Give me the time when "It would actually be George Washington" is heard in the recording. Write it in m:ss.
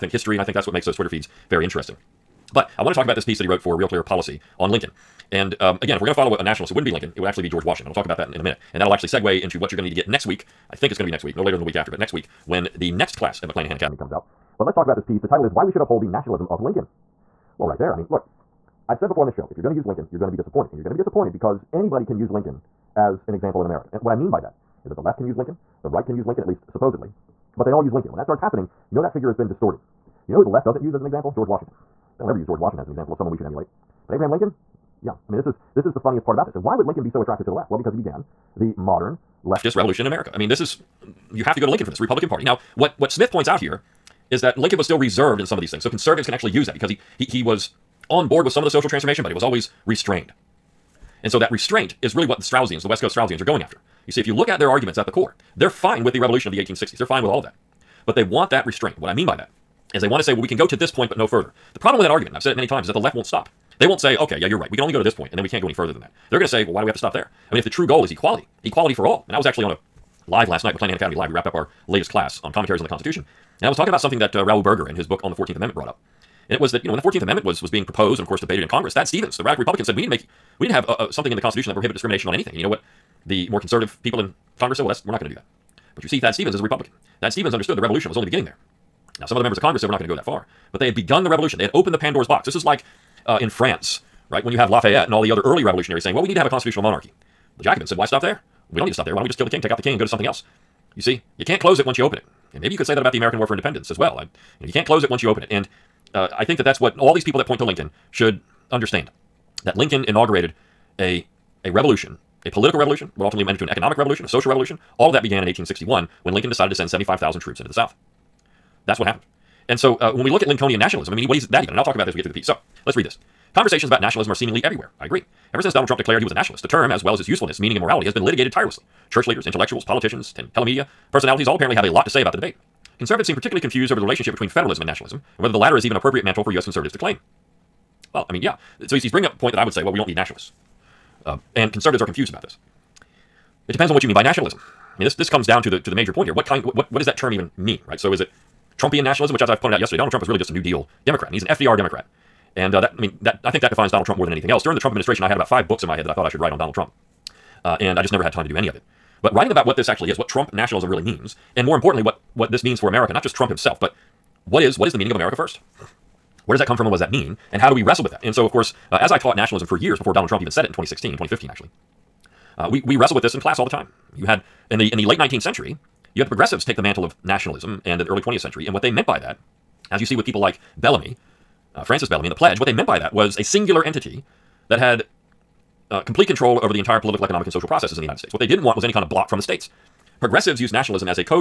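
0:07.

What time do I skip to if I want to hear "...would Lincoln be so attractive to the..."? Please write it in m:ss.
0:36.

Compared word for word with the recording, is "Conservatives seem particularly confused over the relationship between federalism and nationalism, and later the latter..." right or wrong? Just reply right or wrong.
wrong.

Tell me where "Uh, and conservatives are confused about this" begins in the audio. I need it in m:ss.
2:21.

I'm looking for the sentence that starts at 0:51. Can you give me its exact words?
And so that restraint is really what the Straussians, the West Coast Straussians, are going after.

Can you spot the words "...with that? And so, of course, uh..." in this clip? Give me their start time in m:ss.
2:48.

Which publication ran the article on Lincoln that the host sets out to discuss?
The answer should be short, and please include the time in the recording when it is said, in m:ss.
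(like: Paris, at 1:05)
Real Clear Policy, at 0:03.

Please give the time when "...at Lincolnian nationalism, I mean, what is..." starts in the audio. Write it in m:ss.
2:00.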